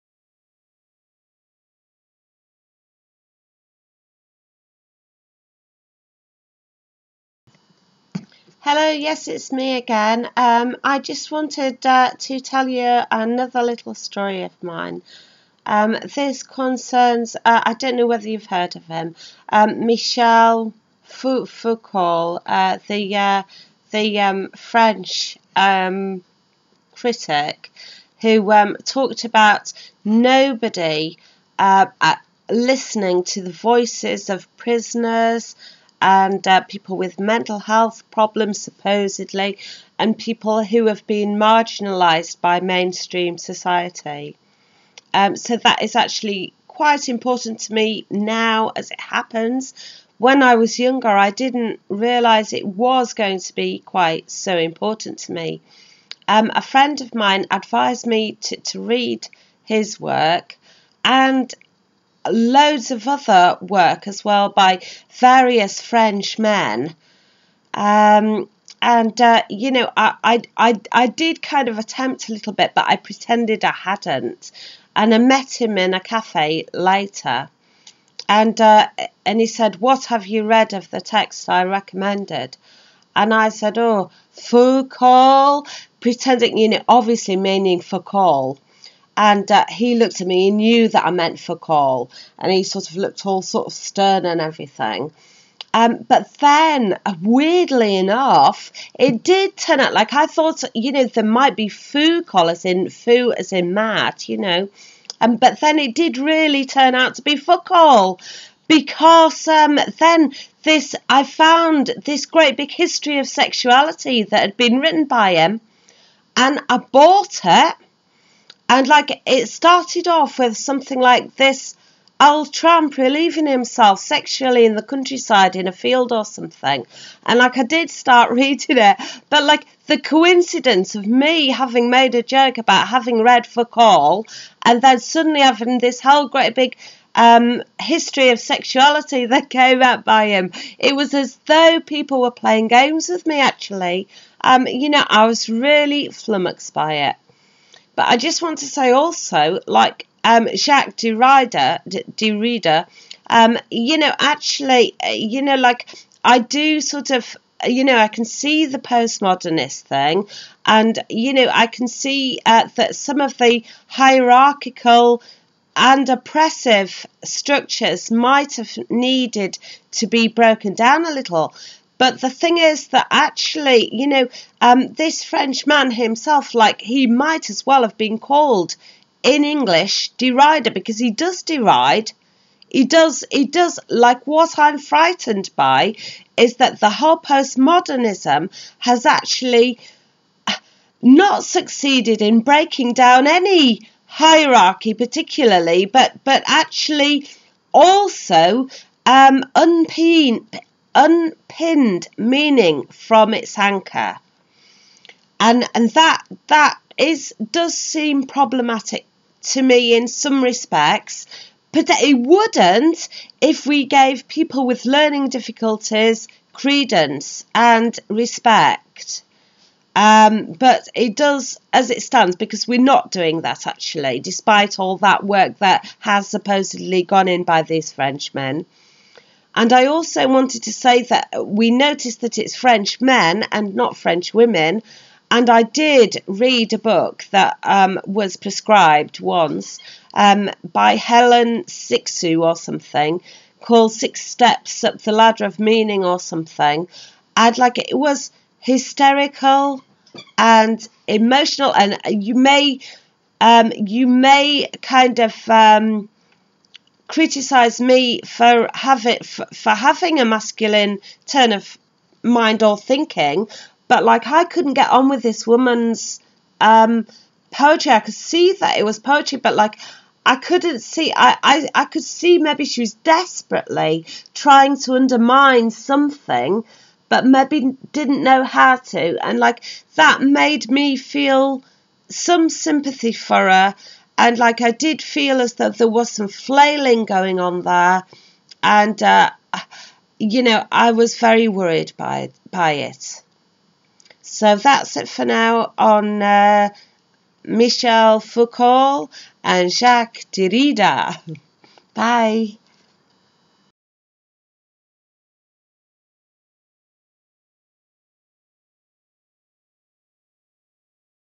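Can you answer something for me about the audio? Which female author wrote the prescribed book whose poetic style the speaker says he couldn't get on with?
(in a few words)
Helen Cixous.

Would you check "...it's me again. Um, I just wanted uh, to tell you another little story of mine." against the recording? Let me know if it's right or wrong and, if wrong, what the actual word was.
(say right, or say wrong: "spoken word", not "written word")
right.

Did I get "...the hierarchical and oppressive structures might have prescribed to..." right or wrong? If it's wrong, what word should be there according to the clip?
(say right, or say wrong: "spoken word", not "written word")
wrong: "needed", not "prescribed".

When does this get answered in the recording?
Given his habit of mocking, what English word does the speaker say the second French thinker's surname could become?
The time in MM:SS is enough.
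03:00.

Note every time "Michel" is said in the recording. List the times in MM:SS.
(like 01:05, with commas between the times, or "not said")
00:19, 04:57.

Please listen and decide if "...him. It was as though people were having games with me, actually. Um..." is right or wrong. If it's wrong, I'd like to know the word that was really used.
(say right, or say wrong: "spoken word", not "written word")
wrong: "playing", not "having".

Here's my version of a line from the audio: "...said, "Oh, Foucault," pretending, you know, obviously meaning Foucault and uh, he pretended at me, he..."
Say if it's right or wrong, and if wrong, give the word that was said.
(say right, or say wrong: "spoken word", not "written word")
wrong: "looked", not "pretended".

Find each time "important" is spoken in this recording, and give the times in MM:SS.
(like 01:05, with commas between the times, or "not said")
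00:47, 00:54.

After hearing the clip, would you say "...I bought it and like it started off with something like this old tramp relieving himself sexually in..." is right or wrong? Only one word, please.
right.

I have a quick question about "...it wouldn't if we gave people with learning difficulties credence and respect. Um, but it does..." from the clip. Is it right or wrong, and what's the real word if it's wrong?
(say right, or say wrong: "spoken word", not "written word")
right.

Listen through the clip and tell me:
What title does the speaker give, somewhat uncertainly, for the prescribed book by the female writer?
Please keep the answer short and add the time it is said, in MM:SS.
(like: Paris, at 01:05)
Six Steps Up the Ladder of Meaning, at 04:03.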